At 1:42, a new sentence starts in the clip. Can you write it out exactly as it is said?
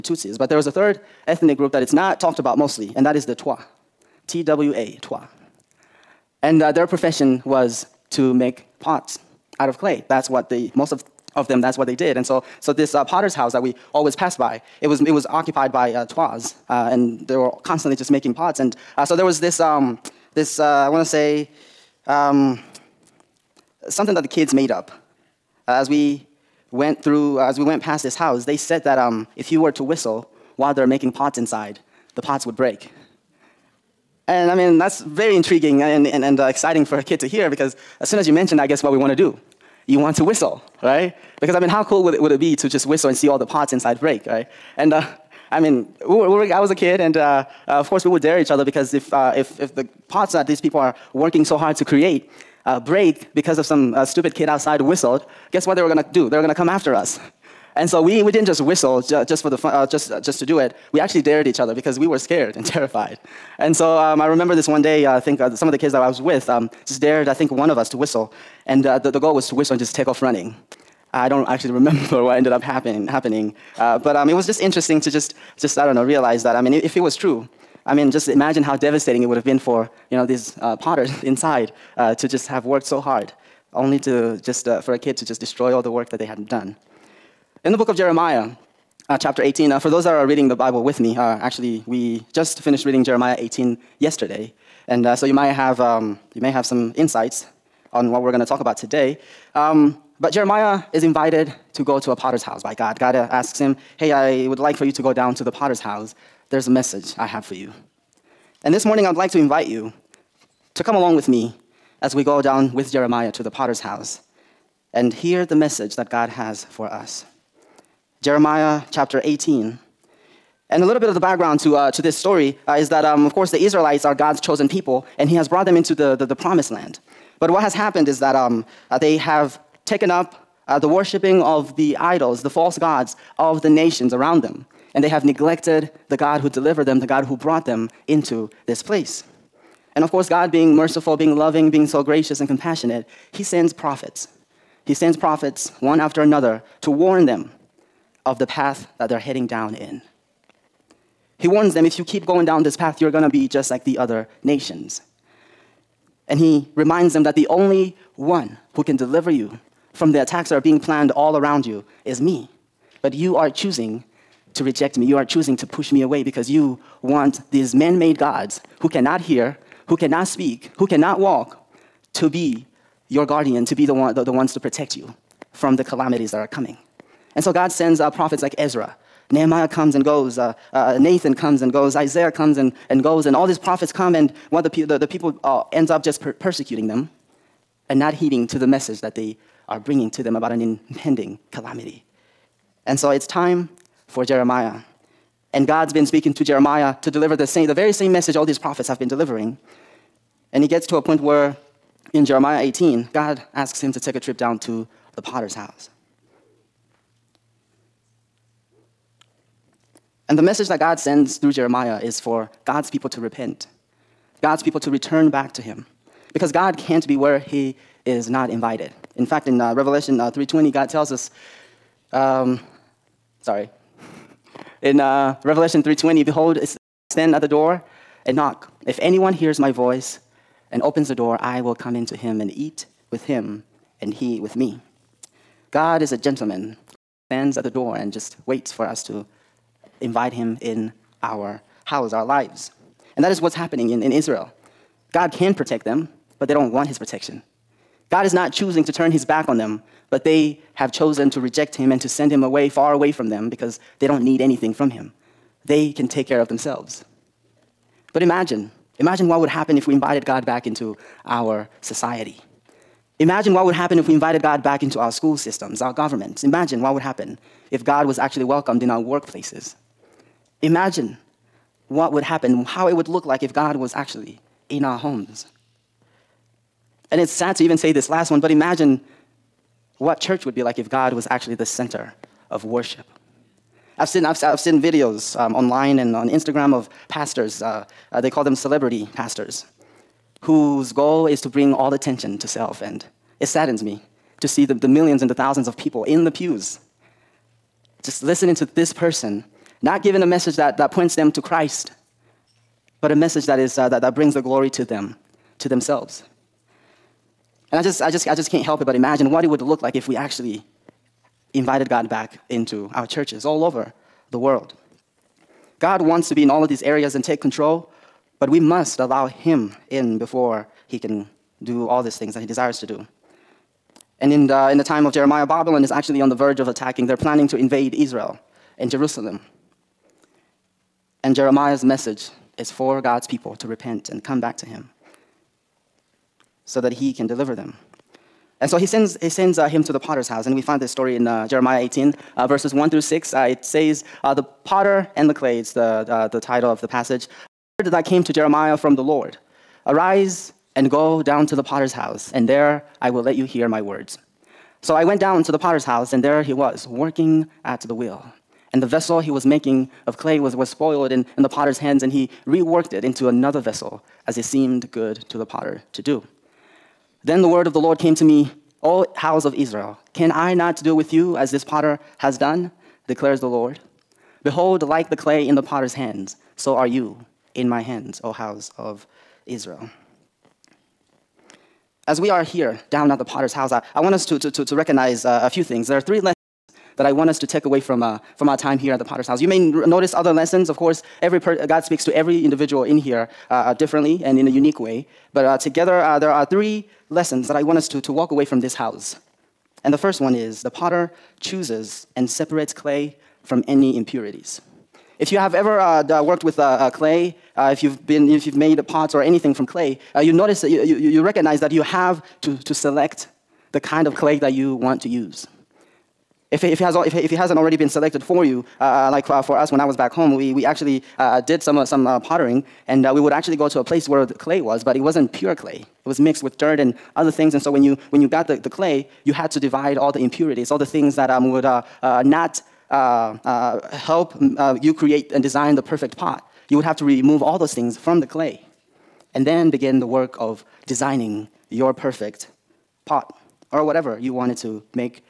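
God uh, asks him, Hey, I would like for you to go down to the potter's house.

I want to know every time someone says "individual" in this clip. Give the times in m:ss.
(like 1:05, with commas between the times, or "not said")
6:32.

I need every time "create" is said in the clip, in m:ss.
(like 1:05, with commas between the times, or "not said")
0:51, 7:14.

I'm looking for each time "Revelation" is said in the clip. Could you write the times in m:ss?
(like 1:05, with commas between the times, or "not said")
3:39, 3:45.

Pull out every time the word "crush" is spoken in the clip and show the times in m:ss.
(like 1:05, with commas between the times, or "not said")
not said.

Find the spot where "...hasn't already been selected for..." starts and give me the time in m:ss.
6:57.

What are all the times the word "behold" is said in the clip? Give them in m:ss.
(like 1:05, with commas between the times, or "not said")
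3:46, 6:14.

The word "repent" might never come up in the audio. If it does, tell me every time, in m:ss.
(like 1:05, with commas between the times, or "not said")
3:33, 5:33.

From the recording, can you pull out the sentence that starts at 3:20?
And he gets to a point where in Jeremiah 18, God asks him to take a trip down to the potter's house.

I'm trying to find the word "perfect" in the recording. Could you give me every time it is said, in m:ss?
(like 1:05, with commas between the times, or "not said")
7:15, 7:21.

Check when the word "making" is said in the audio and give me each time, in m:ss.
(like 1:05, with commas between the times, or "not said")
0:18, 0:30, 5:59.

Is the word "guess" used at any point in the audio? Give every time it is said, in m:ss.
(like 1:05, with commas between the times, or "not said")
0:38, 0:55.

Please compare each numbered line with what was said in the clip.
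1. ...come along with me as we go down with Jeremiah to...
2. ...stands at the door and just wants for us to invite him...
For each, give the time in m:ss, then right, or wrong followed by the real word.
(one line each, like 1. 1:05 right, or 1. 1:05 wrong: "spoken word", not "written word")
1. 1:50 right
2. 3:57 wrong: "waits", not "wants".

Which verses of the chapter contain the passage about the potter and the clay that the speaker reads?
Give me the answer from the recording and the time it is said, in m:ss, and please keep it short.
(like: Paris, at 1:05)
1 through 6, at 5:42.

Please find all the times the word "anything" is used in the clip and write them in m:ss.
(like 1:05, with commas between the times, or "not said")
4:14, 6:49.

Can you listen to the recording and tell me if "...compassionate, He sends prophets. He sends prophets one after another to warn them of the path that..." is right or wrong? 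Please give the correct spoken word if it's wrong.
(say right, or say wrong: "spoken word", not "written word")
right.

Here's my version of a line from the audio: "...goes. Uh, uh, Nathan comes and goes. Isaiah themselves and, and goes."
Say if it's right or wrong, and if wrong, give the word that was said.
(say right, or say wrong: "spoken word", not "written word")
wrong: "comes", not "themselves".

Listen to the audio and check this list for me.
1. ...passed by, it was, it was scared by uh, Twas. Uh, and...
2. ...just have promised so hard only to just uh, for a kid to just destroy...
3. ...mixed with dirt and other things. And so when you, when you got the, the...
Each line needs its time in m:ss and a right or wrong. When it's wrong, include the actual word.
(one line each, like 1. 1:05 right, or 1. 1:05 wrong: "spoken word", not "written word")
1. 0:14 wrong: "occupied", not "scared"
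2. 1:22 wrong: "worked", not "promised"
3. 7:06 right.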